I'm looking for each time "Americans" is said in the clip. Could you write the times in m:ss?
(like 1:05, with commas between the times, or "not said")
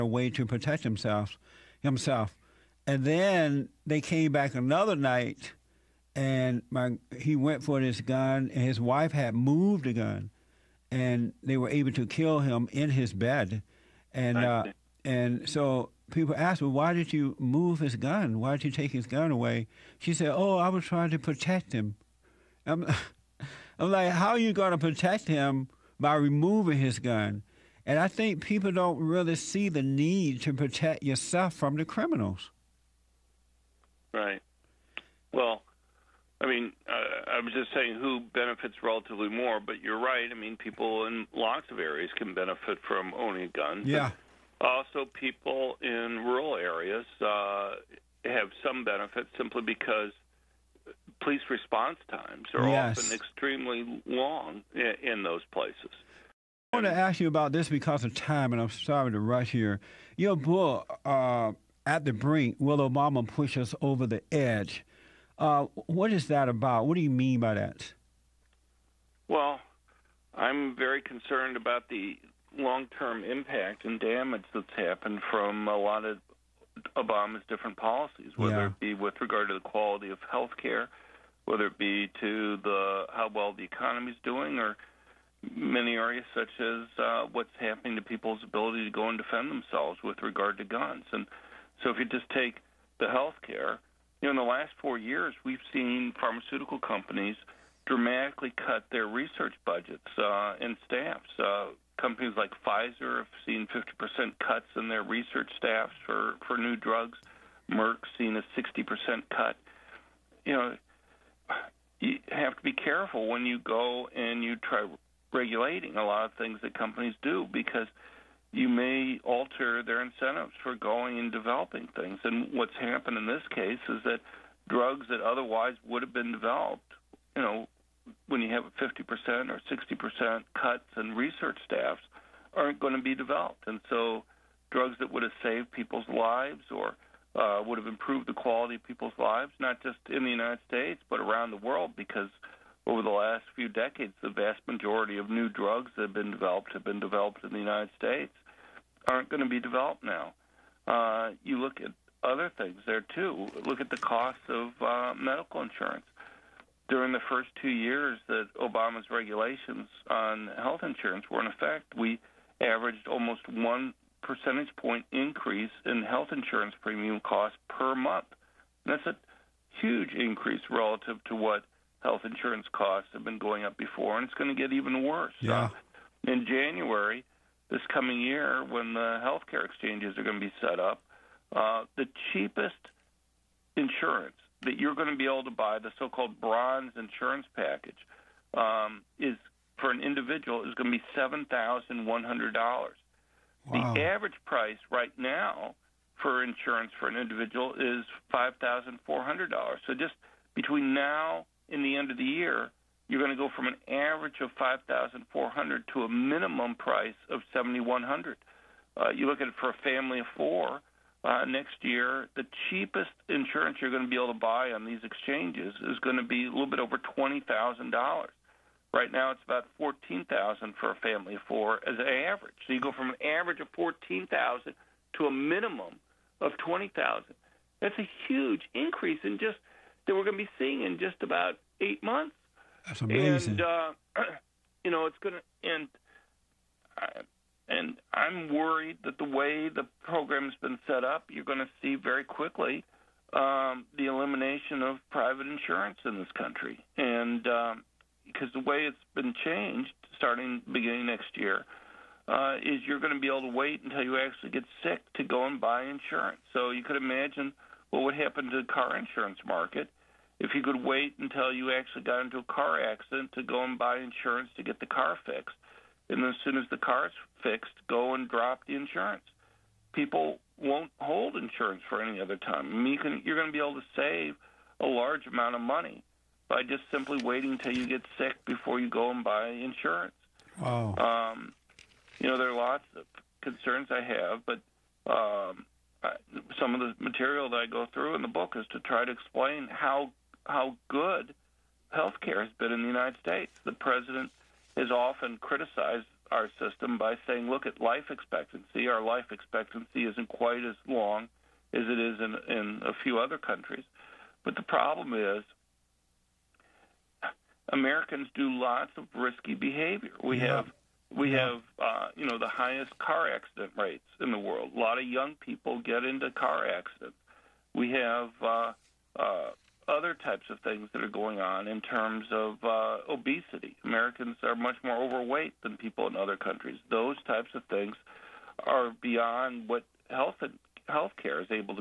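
5:07, 5:23.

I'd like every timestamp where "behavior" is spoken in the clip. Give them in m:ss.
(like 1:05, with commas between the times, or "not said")
5:09.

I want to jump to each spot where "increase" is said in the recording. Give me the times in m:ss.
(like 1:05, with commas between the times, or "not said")
2:45, 2:50, 3:48.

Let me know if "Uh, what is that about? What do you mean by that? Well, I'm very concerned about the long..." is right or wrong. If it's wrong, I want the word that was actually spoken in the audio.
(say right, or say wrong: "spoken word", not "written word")
right.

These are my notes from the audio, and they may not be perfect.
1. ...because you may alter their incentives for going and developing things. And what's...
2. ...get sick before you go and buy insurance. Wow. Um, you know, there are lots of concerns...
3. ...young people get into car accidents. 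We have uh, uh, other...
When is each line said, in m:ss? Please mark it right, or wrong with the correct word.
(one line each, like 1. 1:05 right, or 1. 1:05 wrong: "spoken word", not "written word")
1. 1:57 right
2. 4:37 right
3. 5:15 right.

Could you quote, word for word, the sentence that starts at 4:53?
The president has often criticized our system by saying, "Look at life expectancy.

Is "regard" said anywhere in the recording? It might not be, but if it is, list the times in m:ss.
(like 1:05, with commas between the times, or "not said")
1:19, 1:30.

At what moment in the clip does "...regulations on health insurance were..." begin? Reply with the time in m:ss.
2:39.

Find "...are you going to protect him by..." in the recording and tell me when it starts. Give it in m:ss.
0:24.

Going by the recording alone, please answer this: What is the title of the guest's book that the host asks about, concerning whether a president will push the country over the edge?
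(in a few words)
At the Brink.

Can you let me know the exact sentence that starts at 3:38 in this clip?
Right now, it's about fourteen thousand for a family of four as an average.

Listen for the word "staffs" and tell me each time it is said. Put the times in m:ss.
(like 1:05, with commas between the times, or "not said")
1:40, 1:45, 2:11.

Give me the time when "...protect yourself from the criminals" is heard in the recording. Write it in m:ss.
0:30.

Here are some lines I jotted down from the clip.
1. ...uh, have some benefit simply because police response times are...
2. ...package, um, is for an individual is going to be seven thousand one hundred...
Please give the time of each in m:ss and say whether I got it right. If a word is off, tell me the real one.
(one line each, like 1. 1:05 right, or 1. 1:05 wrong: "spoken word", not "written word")
1. 0:47 right
2. 3:07 right.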